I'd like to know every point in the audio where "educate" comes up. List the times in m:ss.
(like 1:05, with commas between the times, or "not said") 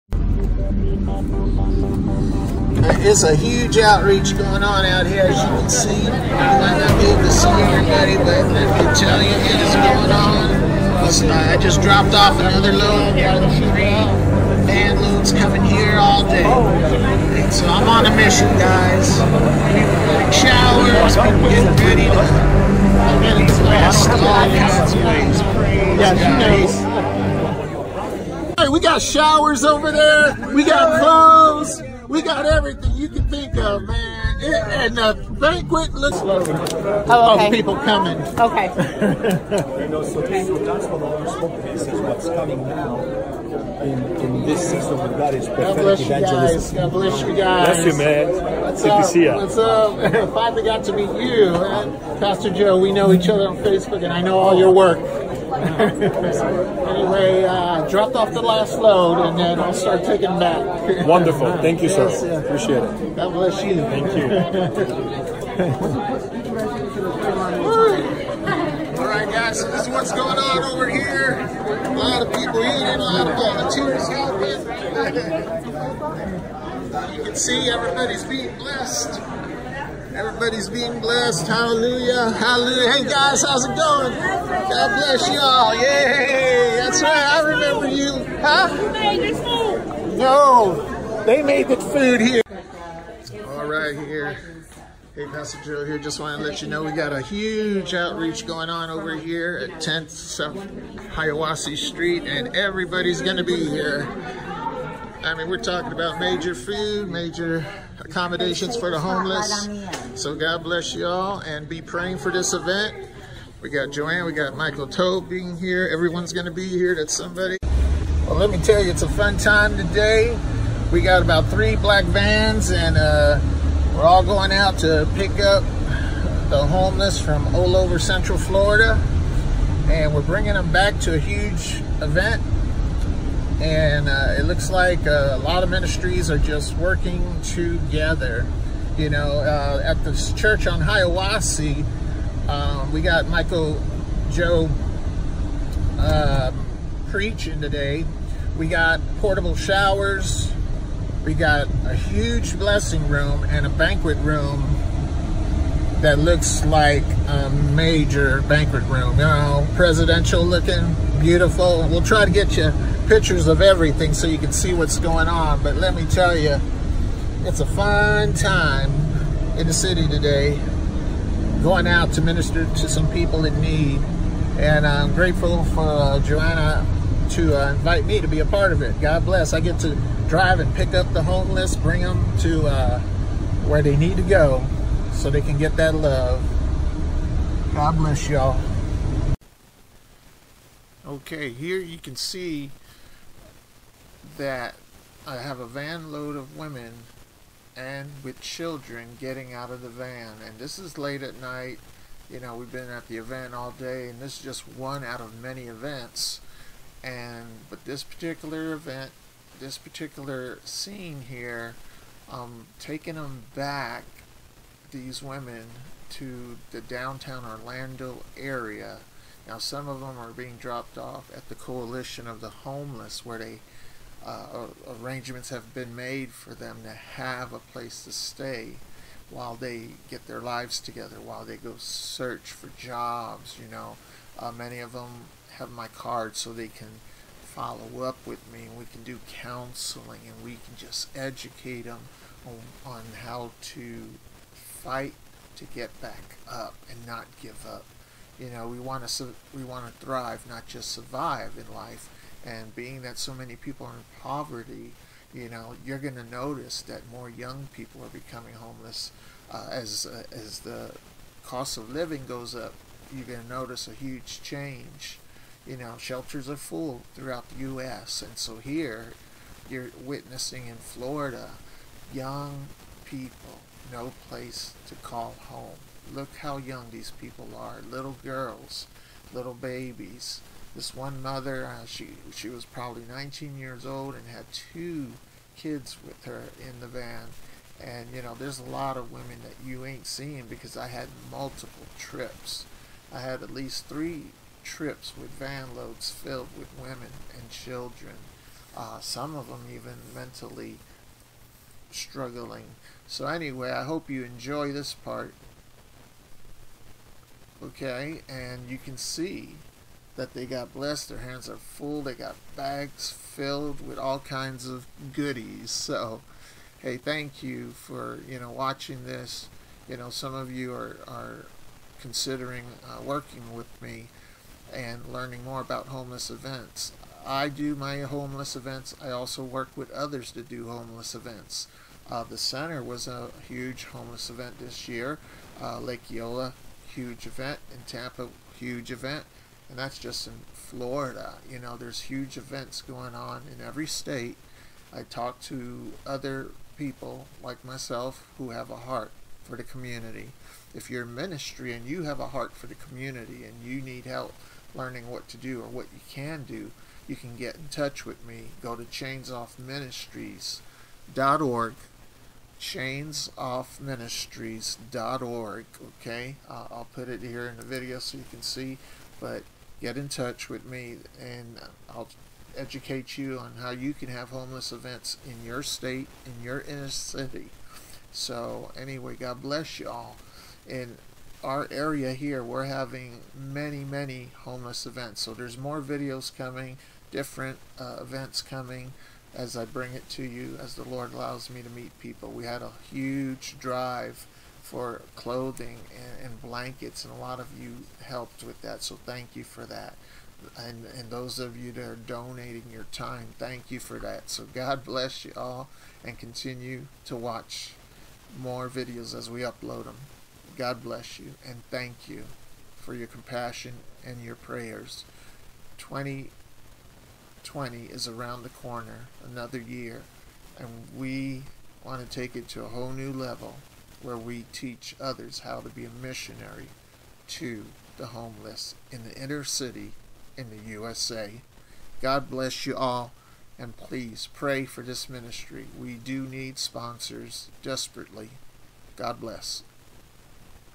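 4:01, 6:12.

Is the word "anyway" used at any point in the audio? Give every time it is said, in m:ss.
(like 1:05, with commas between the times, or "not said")
0:55, 5:03, 6:18.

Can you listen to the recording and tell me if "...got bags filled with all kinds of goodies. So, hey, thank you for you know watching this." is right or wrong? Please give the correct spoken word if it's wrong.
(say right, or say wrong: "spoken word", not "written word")
right.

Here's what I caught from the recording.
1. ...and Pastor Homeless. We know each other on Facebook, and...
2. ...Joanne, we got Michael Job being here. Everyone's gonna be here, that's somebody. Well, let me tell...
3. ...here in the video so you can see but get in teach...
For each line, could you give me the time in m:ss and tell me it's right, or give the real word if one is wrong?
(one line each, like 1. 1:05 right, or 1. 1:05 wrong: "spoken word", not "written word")
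1. 0:51 wrong: "Joe", not "Homeless"
2. 1:53 right
3. 6:07 wrong: "touch", not "teach".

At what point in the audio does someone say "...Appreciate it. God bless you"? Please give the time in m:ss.
1:02.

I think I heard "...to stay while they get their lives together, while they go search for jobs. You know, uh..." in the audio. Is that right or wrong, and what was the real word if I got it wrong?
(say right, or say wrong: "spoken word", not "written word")
right.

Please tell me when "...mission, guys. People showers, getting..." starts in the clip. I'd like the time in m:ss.
0:18.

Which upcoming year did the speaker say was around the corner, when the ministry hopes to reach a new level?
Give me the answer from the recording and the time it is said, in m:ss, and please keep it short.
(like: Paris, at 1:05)
2020, at 6:55.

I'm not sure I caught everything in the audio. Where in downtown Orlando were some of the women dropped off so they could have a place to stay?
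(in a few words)
Coalition of the Homeless.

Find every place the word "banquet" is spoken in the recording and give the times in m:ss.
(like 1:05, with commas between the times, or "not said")
0:35, 2:33, 2:38.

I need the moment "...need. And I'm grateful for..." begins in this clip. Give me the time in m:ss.
2:53.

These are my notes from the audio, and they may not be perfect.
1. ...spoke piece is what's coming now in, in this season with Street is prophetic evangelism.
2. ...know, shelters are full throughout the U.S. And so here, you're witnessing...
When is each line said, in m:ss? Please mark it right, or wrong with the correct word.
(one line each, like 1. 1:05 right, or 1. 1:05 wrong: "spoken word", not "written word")
1. 0:41 wrong: "God", not "Street"
2. 4:25 right.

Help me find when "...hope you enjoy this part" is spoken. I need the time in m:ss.
5:03.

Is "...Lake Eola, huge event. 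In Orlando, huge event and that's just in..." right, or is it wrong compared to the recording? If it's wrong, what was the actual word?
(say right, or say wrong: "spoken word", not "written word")
wrong: "Tampa", not "Orlando".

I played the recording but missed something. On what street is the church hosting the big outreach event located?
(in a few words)
10th South Hiawassee Street.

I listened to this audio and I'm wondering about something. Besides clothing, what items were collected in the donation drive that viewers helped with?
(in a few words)
Blankets.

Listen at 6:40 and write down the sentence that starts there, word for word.
And, and those of you that are donating your time, thank you for that.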